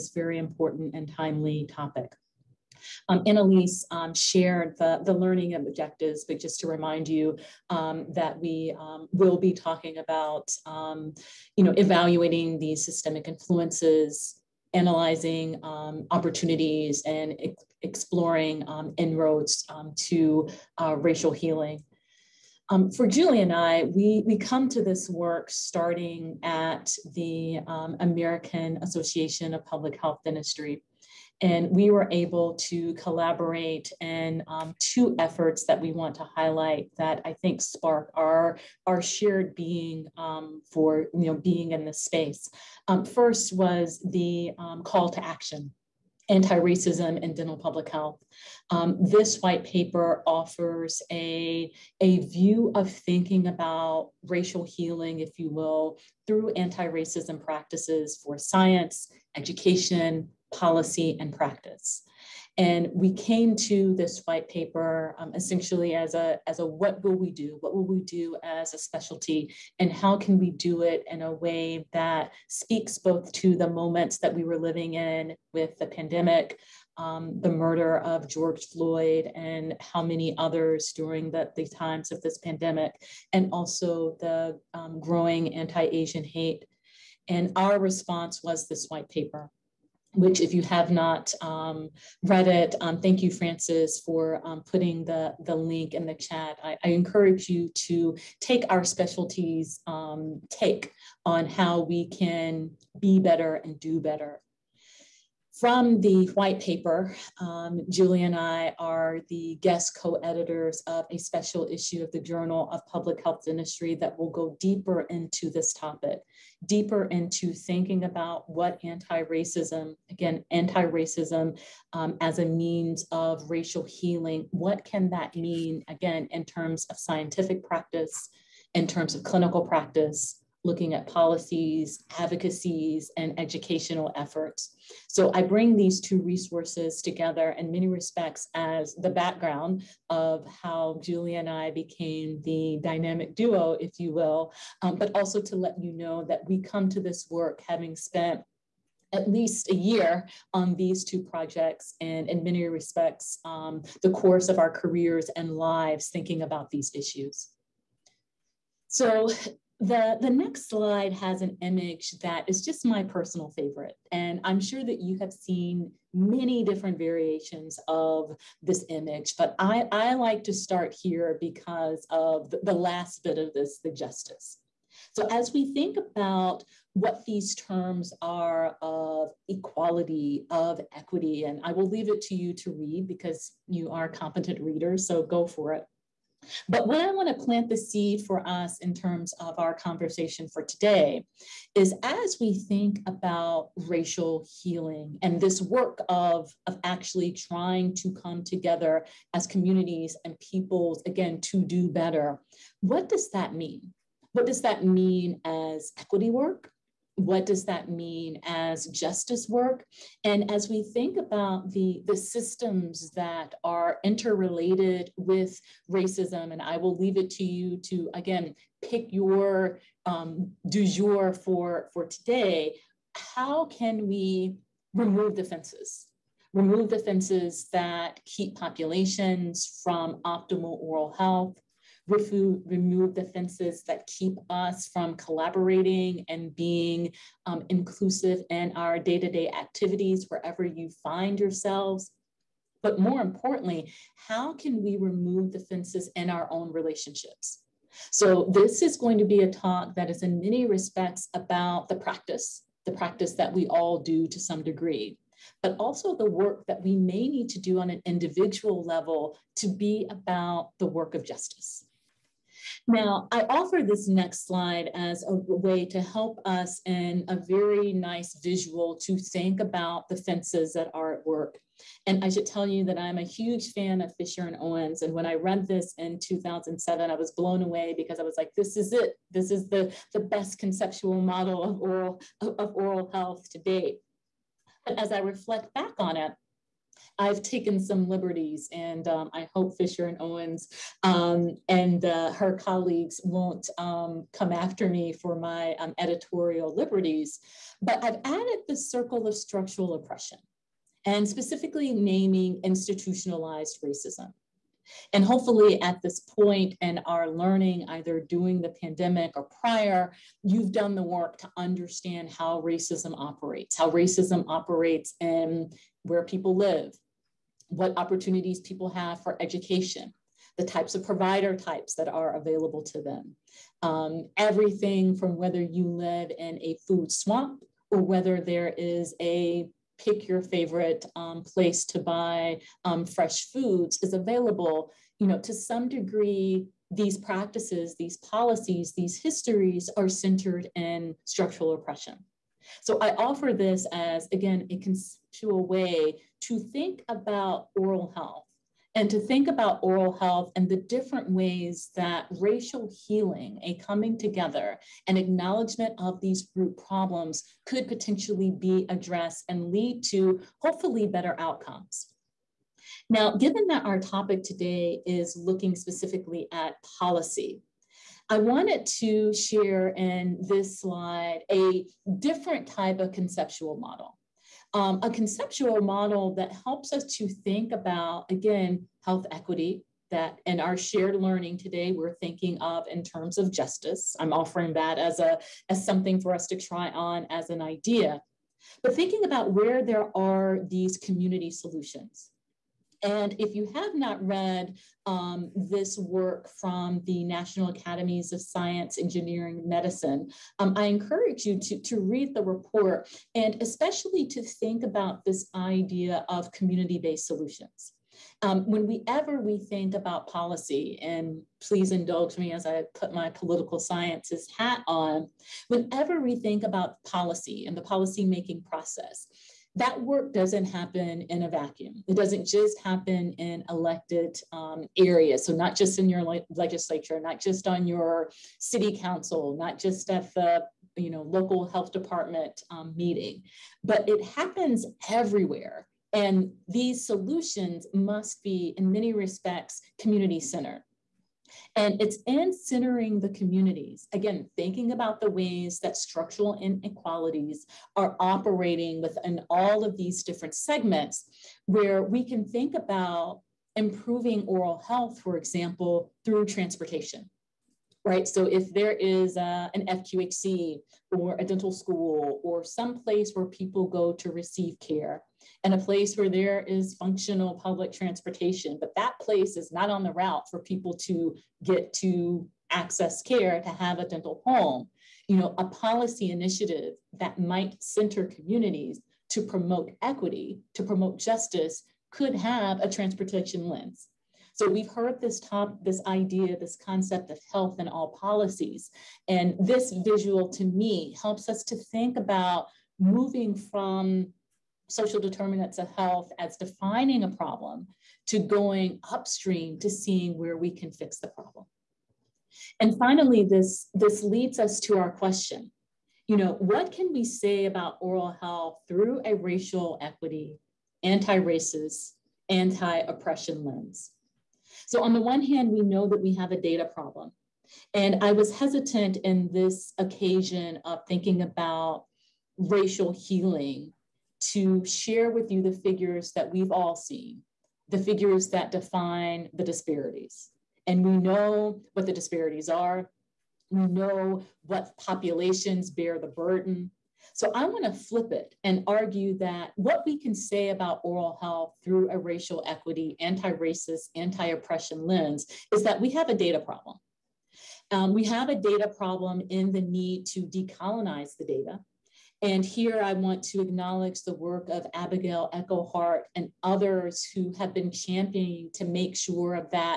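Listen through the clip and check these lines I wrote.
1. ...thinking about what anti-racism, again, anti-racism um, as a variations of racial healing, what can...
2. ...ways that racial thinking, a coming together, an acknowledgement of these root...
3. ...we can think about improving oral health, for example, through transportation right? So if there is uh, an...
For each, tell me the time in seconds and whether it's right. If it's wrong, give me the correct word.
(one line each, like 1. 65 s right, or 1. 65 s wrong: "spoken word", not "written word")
1. 117 s wrong: "means", not "variations"
2. 351 s wrong: "healing", not "thinking"
3. 452 s right.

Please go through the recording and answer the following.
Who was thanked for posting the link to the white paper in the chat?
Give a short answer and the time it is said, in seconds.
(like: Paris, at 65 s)
Francis, at 93 s.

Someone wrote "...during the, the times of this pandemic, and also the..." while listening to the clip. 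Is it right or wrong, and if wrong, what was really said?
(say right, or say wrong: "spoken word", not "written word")
right.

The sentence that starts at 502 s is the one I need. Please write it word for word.
And finally, this, this leads us to our question.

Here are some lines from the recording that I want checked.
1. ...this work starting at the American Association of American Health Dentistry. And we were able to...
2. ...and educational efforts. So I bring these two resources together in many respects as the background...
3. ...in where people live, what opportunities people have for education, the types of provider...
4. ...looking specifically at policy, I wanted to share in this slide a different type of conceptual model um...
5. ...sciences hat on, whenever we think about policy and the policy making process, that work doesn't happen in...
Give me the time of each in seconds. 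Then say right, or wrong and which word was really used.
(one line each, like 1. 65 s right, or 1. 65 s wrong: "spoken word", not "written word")
1. 24 s wrong: "Public", not "American"
2. 133 s right
3. 315 s right
4. 365 s right
5. 413 s right.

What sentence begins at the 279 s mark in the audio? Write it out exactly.
This is the, the best conceptual model of oral, of oral health to date.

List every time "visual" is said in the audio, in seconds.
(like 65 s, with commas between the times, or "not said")
268 s, 490 s.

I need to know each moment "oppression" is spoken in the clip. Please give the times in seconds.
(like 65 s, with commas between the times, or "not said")
299 s, 341 s, 512 s, 544 s.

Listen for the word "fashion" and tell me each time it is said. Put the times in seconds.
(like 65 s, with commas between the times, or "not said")
not said.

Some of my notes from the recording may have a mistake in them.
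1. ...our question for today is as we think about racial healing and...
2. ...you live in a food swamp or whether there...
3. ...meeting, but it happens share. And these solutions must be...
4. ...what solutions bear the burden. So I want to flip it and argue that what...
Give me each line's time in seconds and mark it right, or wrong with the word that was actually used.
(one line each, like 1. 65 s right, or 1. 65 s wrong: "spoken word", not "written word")
1. 189 s wrong: "conversation", not "question"
2. 325 s right
3. 432 s wrong: "everywhere", not "share"
4. 534 s wrong: "populations", not "solutions".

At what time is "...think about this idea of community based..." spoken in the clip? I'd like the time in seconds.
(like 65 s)
404 s.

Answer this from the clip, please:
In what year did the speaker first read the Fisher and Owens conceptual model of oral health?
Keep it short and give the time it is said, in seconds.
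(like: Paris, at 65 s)
2007, at 276 s.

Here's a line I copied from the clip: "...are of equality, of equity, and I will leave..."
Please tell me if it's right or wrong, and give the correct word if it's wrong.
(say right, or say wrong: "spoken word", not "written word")
right.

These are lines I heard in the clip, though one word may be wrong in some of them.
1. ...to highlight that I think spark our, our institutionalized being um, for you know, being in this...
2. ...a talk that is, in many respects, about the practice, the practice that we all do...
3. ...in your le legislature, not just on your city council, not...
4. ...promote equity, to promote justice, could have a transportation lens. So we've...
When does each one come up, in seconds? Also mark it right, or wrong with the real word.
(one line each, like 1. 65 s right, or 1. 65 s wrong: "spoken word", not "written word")
1. 36 s wrong: "shared", not "institutionalized"
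2. 249 s right
3. 425 s right
4. 479 s right.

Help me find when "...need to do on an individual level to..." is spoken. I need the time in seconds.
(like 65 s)
257 s.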